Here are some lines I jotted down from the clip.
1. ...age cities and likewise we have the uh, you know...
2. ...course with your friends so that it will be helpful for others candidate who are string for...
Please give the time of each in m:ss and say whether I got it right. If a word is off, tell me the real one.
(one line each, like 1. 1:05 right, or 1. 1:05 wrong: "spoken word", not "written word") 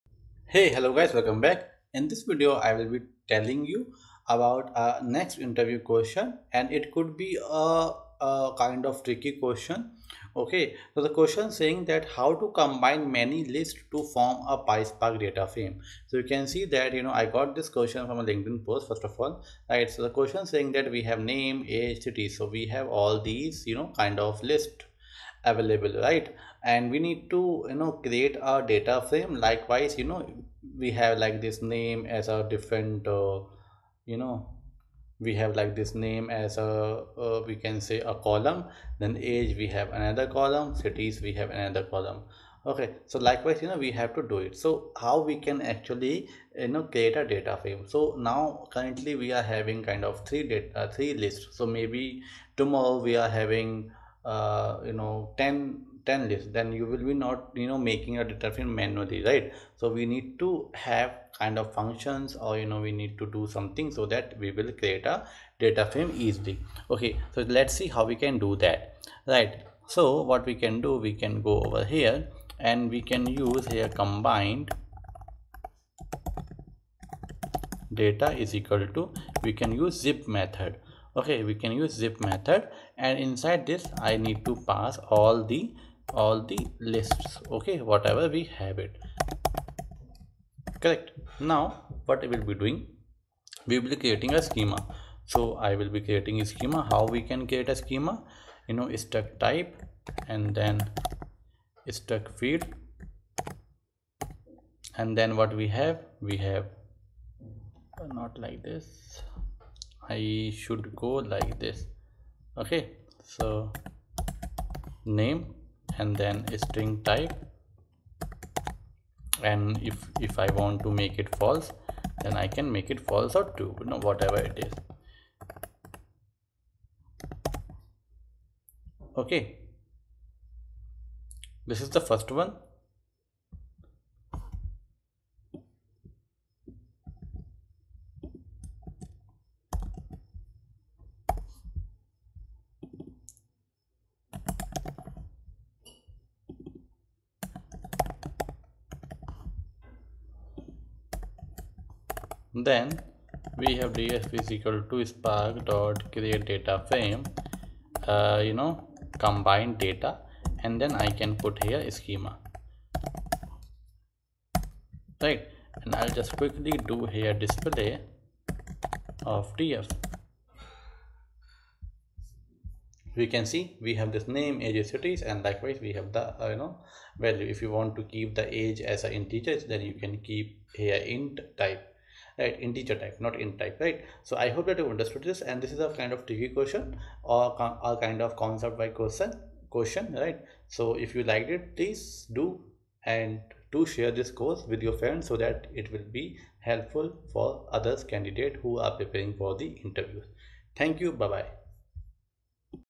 1. 2:54 right
2. 3:14 wrong: "preparing", not "string".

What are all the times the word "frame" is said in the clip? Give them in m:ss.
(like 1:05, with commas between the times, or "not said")
0:15, 0:29, 0:47, 1:05, 2:36.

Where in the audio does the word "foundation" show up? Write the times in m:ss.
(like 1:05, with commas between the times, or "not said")
not said.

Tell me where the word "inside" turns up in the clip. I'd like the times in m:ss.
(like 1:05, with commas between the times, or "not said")
1:23.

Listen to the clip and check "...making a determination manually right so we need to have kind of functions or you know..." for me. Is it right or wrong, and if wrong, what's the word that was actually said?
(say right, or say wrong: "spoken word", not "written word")
right.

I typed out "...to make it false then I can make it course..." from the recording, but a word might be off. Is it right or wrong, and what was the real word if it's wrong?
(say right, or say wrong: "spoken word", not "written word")
wrong: "false", not "course".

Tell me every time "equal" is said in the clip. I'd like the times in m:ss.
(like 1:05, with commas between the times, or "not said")
1:18, 2:34.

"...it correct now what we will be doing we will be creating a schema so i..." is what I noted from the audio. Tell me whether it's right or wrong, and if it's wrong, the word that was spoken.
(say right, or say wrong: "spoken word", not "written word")
right.